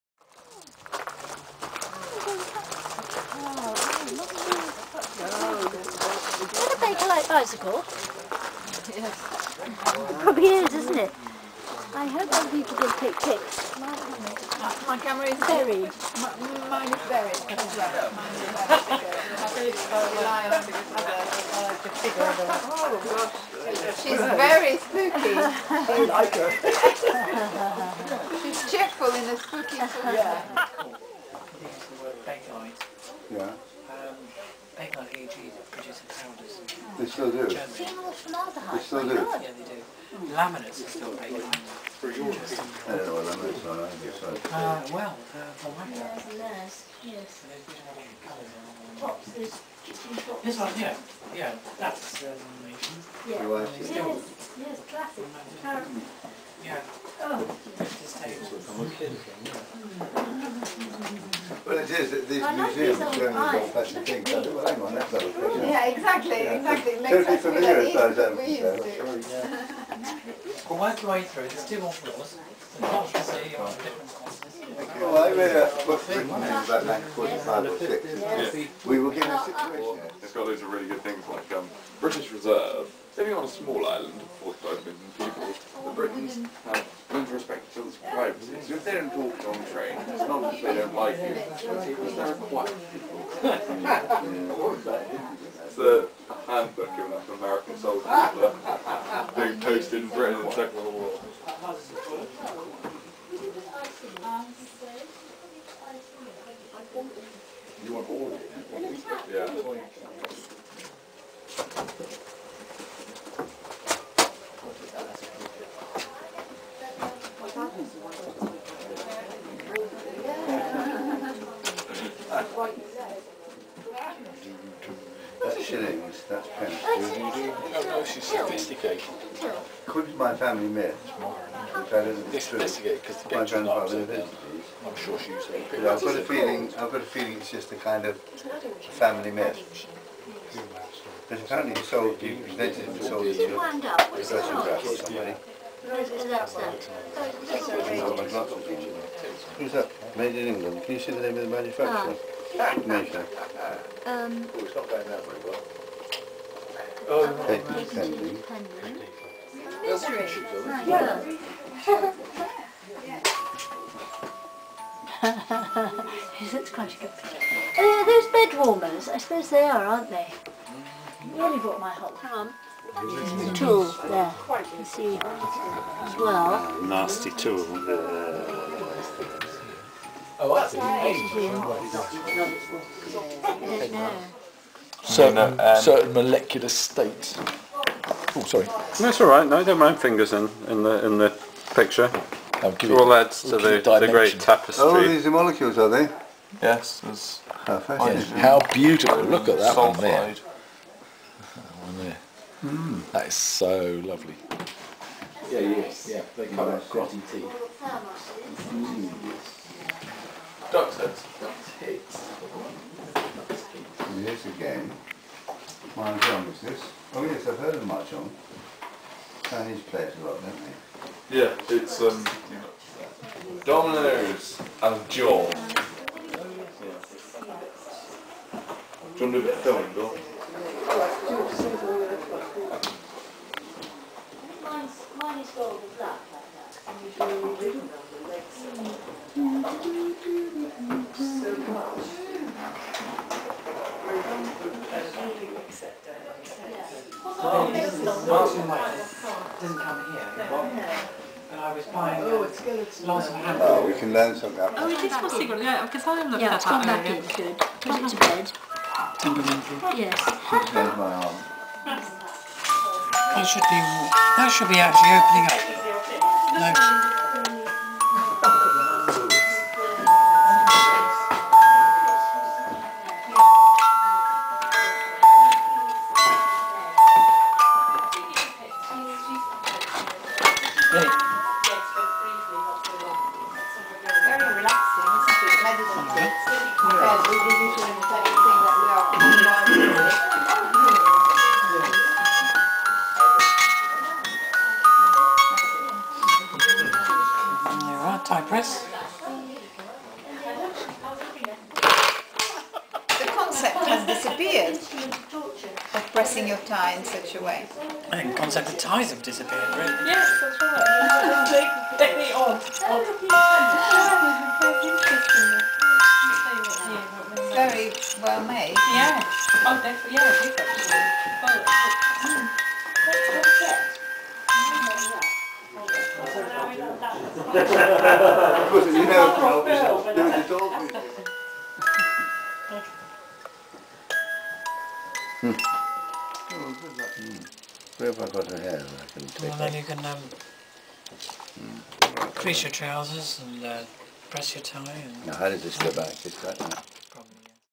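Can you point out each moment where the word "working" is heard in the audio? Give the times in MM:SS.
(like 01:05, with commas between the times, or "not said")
01:10.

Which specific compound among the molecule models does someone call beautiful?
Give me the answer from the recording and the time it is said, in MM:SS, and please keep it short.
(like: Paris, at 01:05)
Sulfide, at 03:19.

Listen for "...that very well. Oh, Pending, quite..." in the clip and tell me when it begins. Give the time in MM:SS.
02:35.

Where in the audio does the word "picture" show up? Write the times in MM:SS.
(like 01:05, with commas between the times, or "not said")
02:47, 03:11.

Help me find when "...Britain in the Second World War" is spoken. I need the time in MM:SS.
01:40.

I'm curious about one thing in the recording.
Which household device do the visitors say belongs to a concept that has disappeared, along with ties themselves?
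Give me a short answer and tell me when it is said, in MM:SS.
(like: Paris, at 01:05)
tie press, at 04:58.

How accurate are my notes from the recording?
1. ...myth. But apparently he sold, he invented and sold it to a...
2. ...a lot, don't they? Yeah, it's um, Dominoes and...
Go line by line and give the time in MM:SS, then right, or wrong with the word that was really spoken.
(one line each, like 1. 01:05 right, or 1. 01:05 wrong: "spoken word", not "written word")
1. 02:19 right
2. 03:40 right.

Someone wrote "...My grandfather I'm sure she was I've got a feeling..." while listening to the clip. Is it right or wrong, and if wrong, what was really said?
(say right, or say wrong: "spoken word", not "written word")
right.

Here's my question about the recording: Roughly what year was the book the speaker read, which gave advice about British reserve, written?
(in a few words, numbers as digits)
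1945.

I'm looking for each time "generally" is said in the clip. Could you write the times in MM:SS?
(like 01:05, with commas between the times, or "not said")
01:03.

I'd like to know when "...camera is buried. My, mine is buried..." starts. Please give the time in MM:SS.
00:15.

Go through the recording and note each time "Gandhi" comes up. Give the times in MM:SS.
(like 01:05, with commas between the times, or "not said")
not said.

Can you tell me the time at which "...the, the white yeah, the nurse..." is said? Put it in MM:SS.
00:45.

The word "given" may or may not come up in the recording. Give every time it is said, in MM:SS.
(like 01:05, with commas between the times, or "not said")
01:19, 01:36.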